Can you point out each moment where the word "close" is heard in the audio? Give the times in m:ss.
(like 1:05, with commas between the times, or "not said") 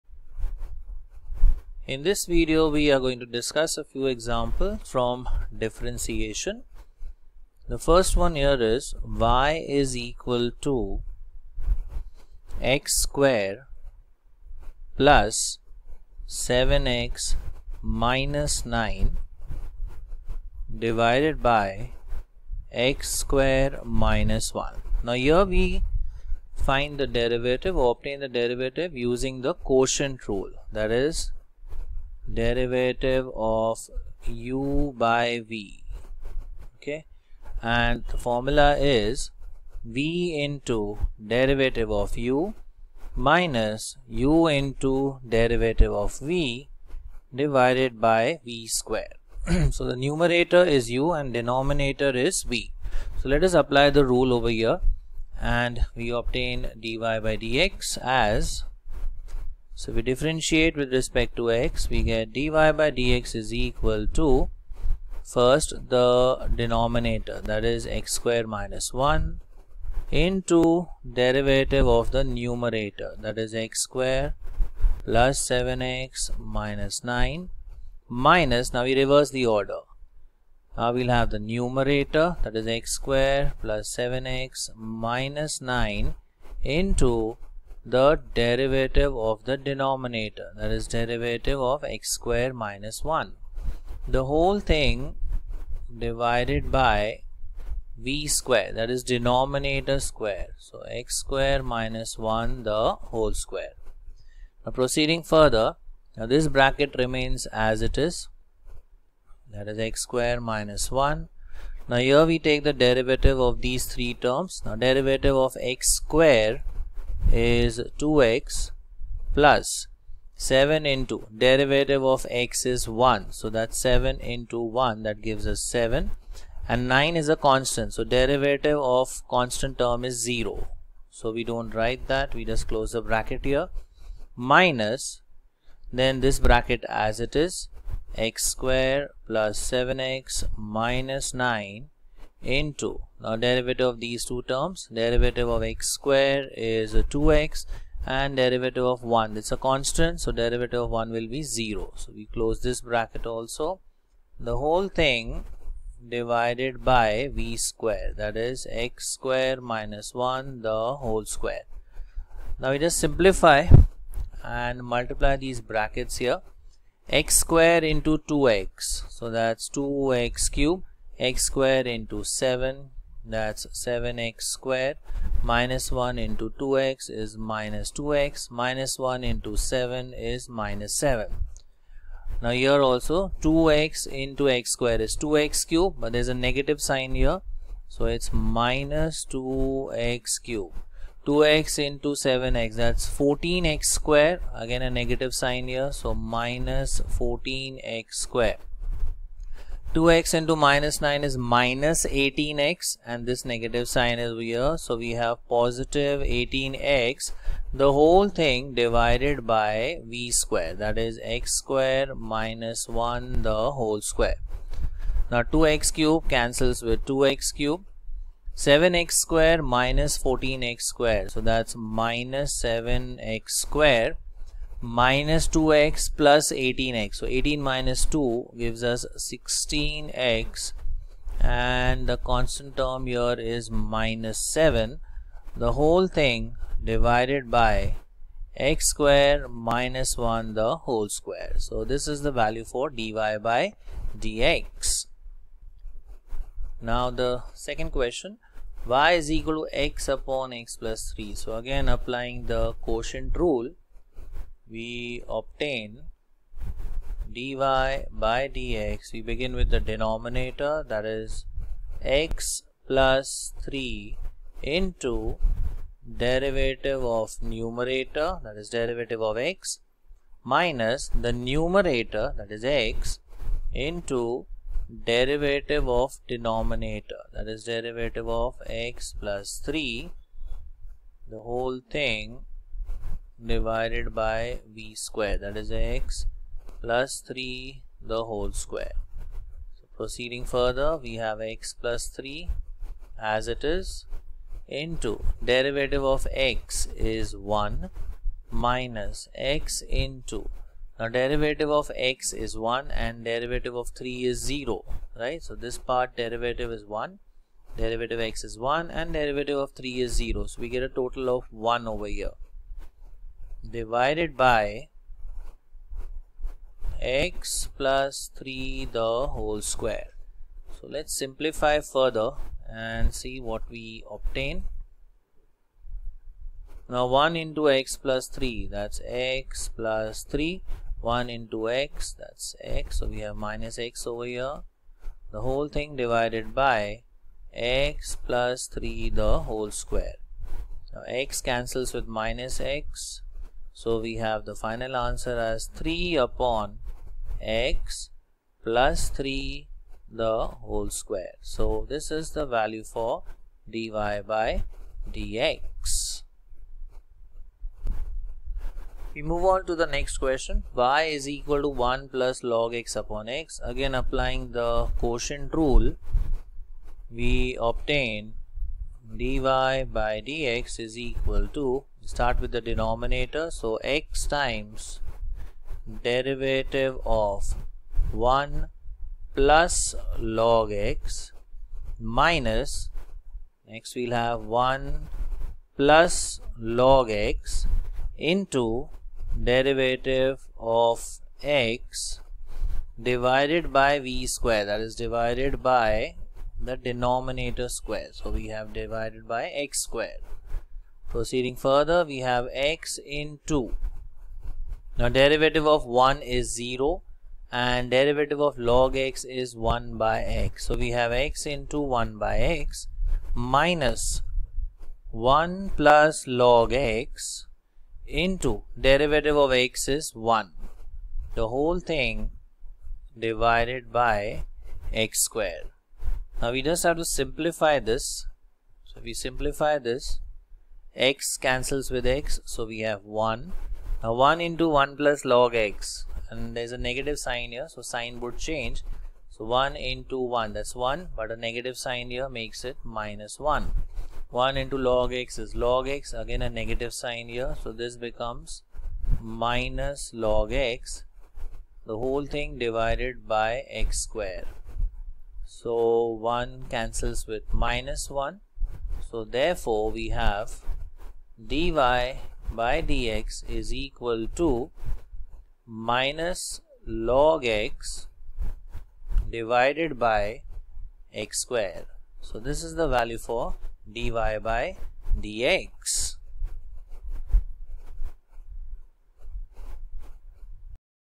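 2:12, 2:32.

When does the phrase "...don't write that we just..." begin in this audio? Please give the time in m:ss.
2:11.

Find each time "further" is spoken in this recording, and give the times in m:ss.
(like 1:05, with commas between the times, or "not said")
1:45, 4:50, 5:21, 6:41.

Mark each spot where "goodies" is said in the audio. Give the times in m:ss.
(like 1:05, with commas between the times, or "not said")
not said.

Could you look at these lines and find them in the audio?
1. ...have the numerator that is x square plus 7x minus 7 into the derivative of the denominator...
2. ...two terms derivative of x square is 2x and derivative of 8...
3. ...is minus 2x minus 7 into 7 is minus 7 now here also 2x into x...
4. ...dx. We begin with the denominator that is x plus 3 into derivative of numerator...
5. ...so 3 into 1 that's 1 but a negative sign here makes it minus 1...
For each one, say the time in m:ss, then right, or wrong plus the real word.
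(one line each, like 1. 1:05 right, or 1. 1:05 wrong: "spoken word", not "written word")
1. 1:21 wrong: "9", not "7"
2. 2:24 wrong: "1", not "8"
3. 2:57 wrong: "1", not "7"
4. 4:18 right
5. 7:19 wrong: "1", not "3".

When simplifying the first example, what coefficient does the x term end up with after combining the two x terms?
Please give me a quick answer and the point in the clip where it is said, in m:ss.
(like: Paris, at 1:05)
16, at 3:49.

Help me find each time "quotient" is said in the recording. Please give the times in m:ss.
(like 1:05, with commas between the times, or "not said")
0:29, 4:12, 6:04.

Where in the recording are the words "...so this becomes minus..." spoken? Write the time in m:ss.
7:27.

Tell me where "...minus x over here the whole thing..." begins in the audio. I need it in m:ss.
5:33.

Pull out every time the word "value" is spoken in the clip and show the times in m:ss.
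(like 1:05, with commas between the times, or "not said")
4:02, 5:52, 7:52.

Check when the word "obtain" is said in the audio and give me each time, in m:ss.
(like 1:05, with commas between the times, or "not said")
0:27, 0:56, 4:15, 5:24, 6:07.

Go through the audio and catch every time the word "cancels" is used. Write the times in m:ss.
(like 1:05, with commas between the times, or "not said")
3:36, 5:41, 7:11, 7:36.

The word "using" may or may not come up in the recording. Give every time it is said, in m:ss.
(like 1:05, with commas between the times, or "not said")
0:29.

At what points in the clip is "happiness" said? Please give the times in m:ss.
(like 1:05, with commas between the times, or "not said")
not said.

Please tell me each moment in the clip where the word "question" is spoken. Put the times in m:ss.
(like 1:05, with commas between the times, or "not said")
4:07, 6:00.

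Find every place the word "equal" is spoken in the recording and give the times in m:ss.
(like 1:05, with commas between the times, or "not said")
0:10, 1:03, 4:09, 6:01, 6:10, 7:43.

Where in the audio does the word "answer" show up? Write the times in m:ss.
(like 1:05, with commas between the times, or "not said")
5:44.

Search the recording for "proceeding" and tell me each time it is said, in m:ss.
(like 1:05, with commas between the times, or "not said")
1:44, 4:49, 6:41.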